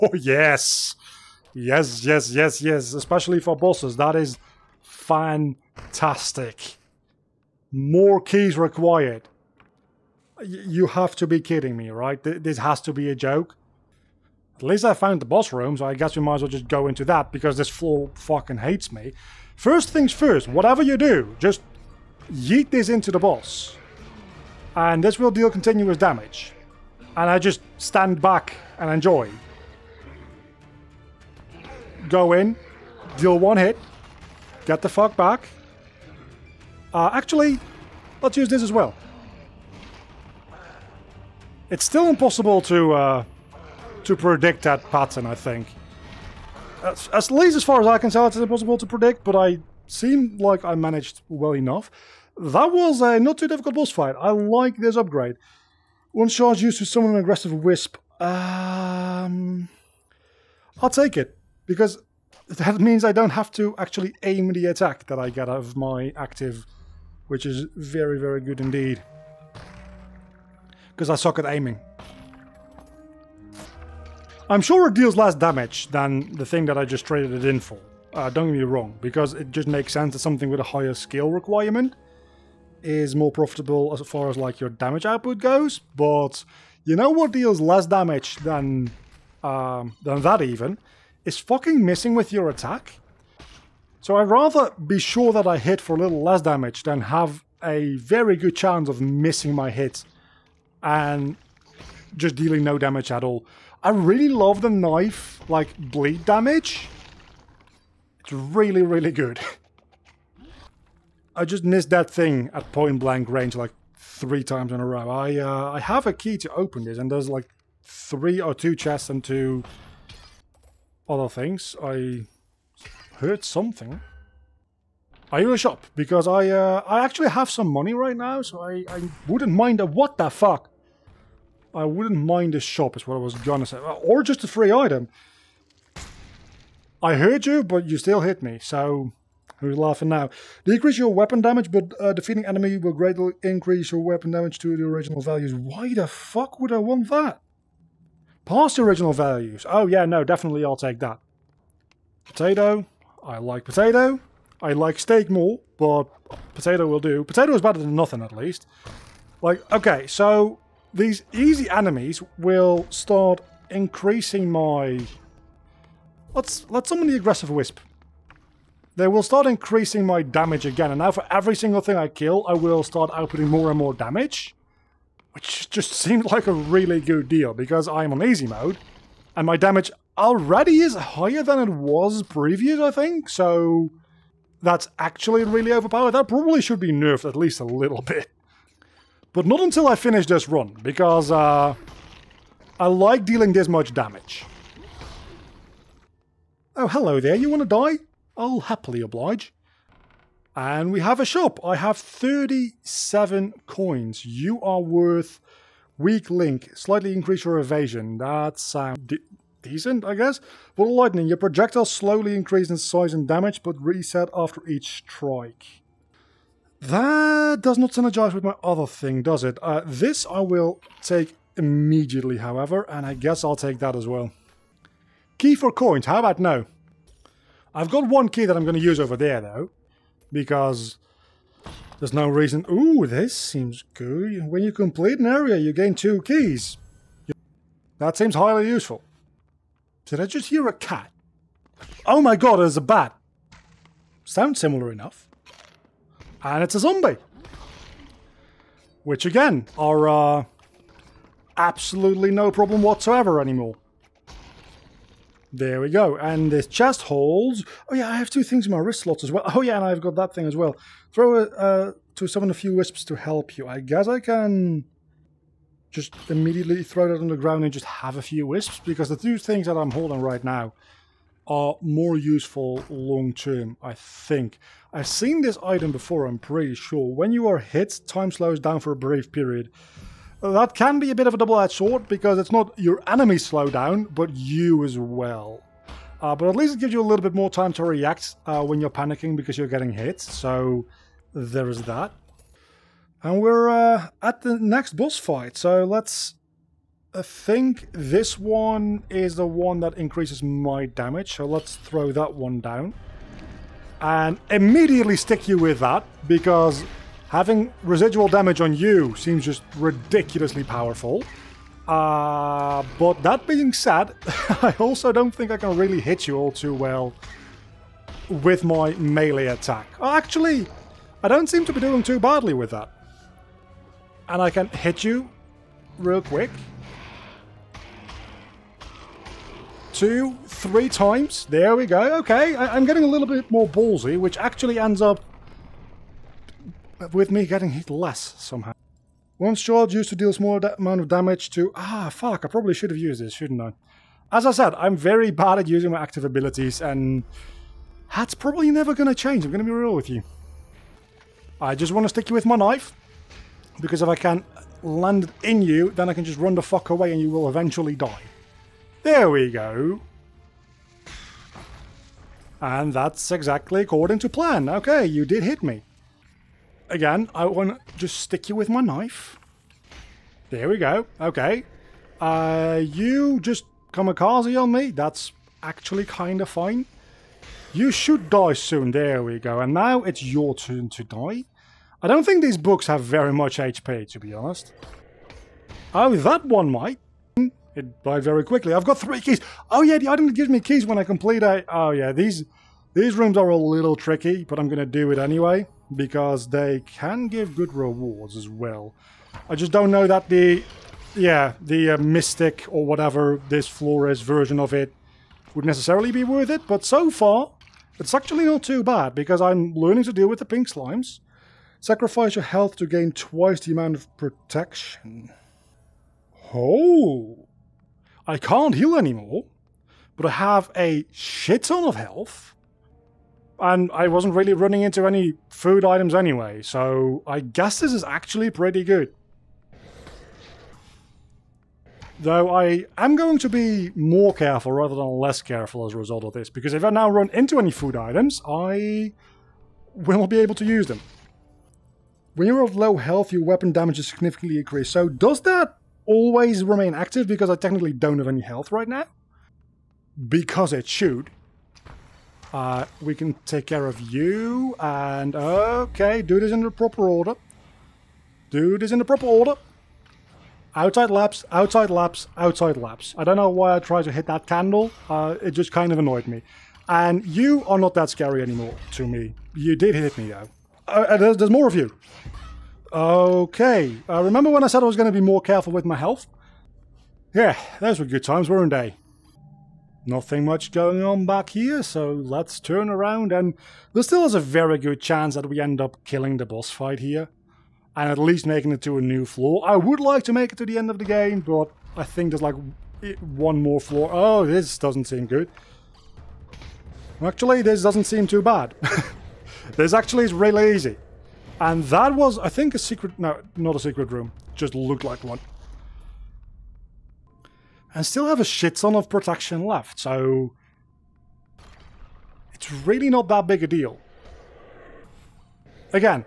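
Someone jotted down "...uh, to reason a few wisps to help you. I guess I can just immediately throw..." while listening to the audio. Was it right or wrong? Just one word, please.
wrong.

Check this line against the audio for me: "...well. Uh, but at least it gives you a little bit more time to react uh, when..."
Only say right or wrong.
right.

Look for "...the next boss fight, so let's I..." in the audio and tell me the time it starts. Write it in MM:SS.
04:54.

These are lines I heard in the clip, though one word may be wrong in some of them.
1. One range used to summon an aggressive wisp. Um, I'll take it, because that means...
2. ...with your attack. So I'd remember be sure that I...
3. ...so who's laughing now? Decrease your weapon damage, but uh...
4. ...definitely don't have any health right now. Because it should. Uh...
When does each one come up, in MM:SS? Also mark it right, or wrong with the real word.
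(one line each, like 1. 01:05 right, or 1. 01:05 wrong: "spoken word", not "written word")
1. 00:56 wrong: "charge", not "range"
2. 01:32 wrong: "rather", not "remember"
3. 02:18 right
4. 07:27 wrong: "technically", not "definitely".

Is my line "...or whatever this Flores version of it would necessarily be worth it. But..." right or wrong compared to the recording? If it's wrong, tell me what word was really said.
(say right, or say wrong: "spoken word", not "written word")
right.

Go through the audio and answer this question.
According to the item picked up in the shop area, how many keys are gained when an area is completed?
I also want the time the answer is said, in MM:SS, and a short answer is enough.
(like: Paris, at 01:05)
2, at 03:55.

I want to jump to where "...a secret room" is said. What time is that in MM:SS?
08:23.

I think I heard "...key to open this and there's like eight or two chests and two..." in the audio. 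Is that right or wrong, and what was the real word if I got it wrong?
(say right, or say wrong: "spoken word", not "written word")
wrong: "three", not "eight".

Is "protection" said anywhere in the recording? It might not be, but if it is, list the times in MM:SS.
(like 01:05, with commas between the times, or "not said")
06:54, 08:29.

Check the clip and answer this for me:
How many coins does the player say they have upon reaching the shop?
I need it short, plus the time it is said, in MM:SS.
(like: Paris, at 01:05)
37, at 03:21.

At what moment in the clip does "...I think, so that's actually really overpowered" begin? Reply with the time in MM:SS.
03:02.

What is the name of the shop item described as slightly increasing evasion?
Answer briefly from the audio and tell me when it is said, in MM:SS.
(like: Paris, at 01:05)
Weak link, at 03:25.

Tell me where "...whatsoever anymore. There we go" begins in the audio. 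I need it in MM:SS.
04:12.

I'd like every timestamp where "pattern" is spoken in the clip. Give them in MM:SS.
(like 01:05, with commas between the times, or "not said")
00:44.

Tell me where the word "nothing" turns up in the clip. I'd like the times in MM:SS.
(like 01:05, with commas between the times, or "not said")
02:37, 08:00.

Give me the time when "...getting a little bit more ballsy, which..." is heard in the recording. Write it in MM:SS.
05:32.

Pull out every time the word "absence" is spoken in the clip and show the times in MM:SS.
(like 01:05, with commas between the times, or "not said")
not said.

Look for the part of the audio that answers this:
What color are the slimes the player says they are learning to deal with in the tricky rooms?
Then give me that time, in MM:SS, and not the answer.
06:50.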